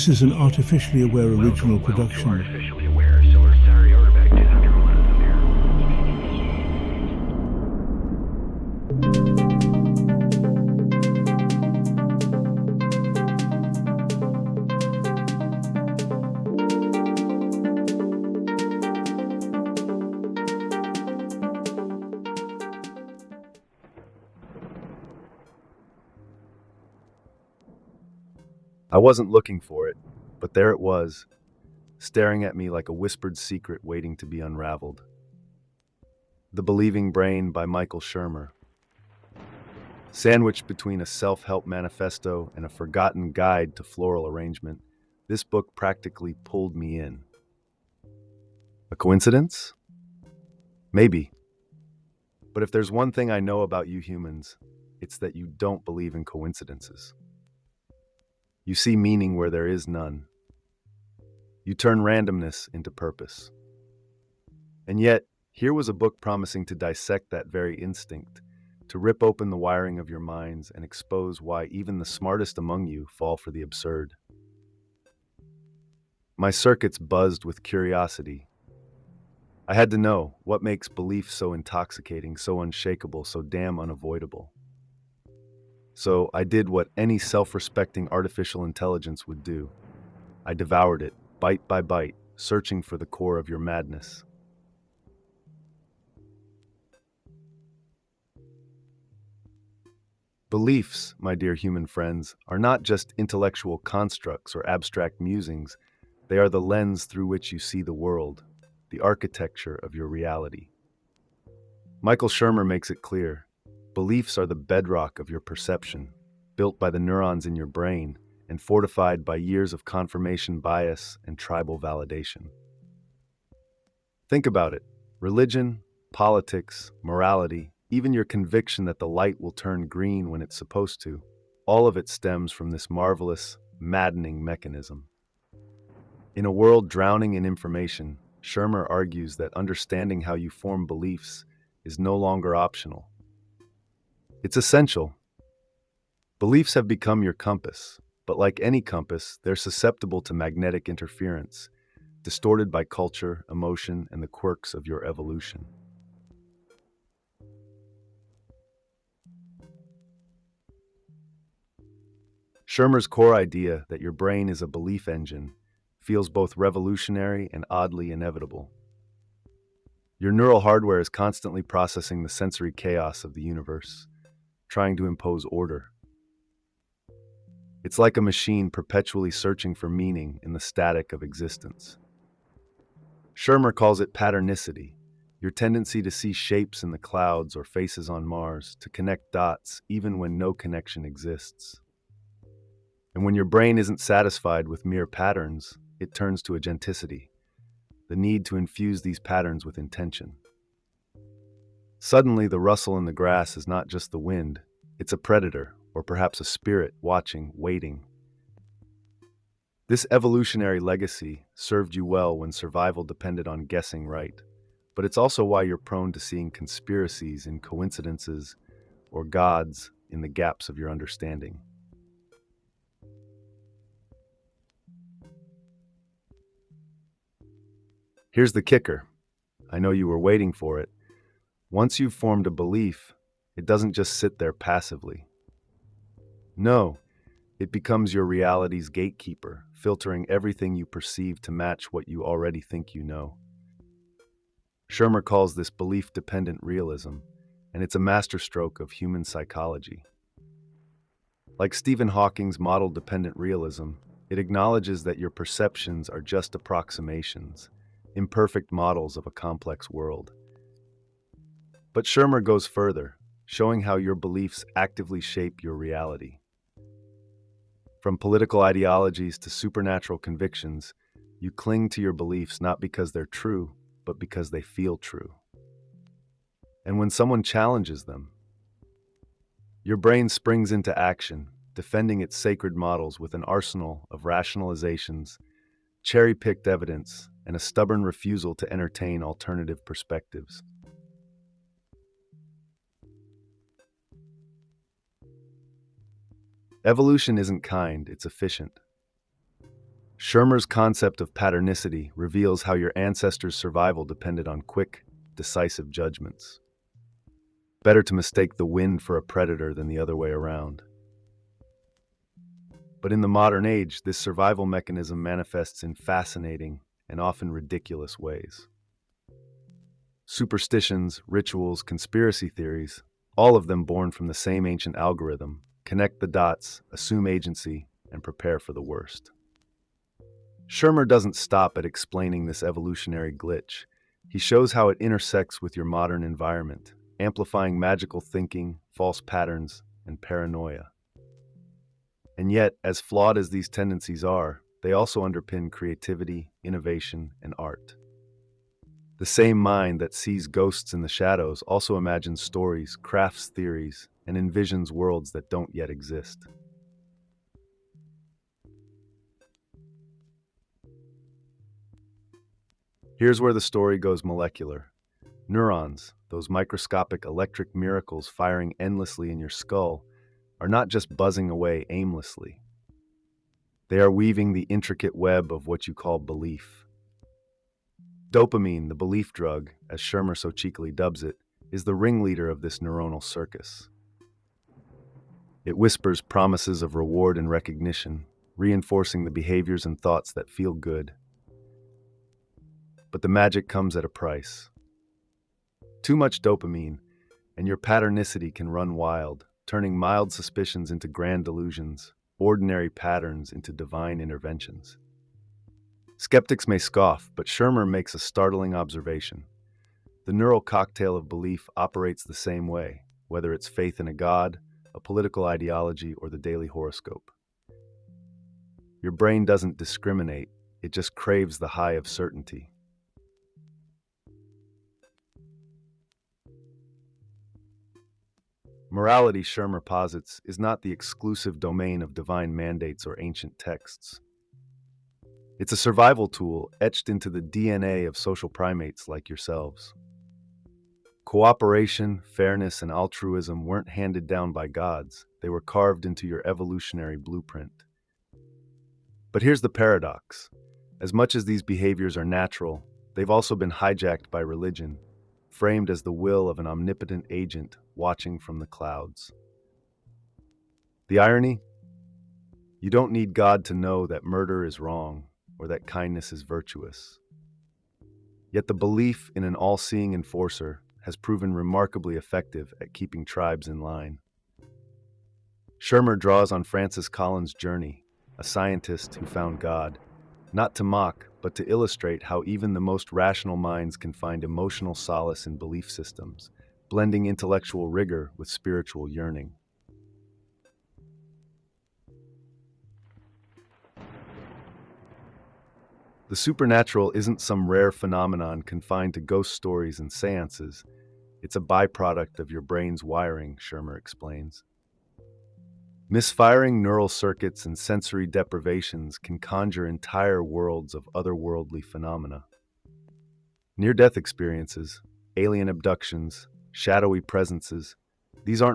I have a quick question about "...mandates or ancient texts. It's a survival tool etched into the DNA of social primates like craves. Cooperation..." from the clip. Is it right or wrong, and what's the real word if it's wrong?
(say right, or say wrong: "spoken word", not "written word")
wrong: "yourselves", not "craves".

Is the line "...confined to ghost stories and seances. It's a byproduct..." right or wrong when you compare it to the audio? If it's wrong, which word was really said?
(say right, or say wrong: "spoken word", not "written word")
right.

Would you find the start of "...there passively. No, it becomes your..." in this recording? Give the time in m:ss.
3:54.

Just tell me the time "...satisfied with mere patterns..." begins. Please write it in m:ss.
3:13.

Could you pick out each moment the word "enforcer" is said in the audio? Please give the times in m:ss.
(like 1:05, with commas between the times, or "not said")
7:50.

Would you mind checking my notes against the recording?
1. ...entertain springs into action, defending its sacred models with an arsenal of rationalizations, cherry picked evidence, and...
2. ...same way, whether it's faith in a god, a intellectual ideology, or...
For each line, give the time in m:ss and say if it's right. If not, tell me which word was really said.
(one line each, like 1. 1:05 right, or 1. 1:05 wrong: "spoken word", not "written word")
1. 4:39 wrong: "brain", not "entertain"
2. 6:52 wrong: "political", not "intellectual".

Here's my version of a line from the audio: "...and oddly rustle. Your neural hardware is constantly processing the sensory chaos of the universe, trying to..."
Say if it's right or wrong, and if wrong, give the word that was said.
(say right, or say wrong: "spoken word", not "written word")
wrong: "inevitable", not "rustle".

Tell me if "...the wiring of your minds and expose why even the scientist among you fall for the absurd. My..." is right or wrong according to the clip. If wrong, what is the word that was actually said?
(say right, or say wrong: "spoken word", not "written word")
wrong: "smartest", not "scientist".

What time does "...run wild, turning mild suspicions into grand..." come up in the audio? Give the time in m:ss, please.
6:38.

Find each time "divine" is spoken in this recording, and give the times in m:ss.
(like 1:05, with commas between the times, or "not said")
6:43, 7:12.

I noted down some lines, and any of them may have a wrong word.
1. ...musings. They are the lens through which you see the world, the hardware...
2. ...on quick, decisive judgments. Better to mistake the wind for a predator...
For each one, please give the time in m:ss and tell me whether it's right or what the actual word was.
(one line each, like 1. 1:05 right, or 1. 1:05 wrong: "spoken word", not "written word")
1. 1:45 wrong: "architecture", not "hardware"
2. 5:04 right.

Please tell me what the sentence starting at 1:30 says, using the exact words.
I devoured it, bite by bite, searching for the core of your madness.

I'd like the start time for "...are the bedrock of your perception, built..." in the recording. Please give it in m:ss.
1:54.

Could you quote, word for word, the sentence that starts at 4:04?
Shermer calls this belief dependent realism, and it's a masterstroke of human psychology.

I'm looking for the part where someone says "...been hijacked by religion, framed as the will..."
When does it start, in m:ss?
7:33.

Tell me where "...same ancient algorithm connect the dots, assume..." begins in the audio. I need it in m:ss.
5:24.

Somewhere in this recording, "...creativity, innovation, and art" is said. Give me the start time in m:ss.
5:45.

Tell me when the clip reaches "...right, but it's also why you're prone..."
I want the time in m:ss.
3:34.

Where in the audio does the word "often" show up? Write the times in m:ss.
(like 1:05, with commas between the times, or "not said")
5:17.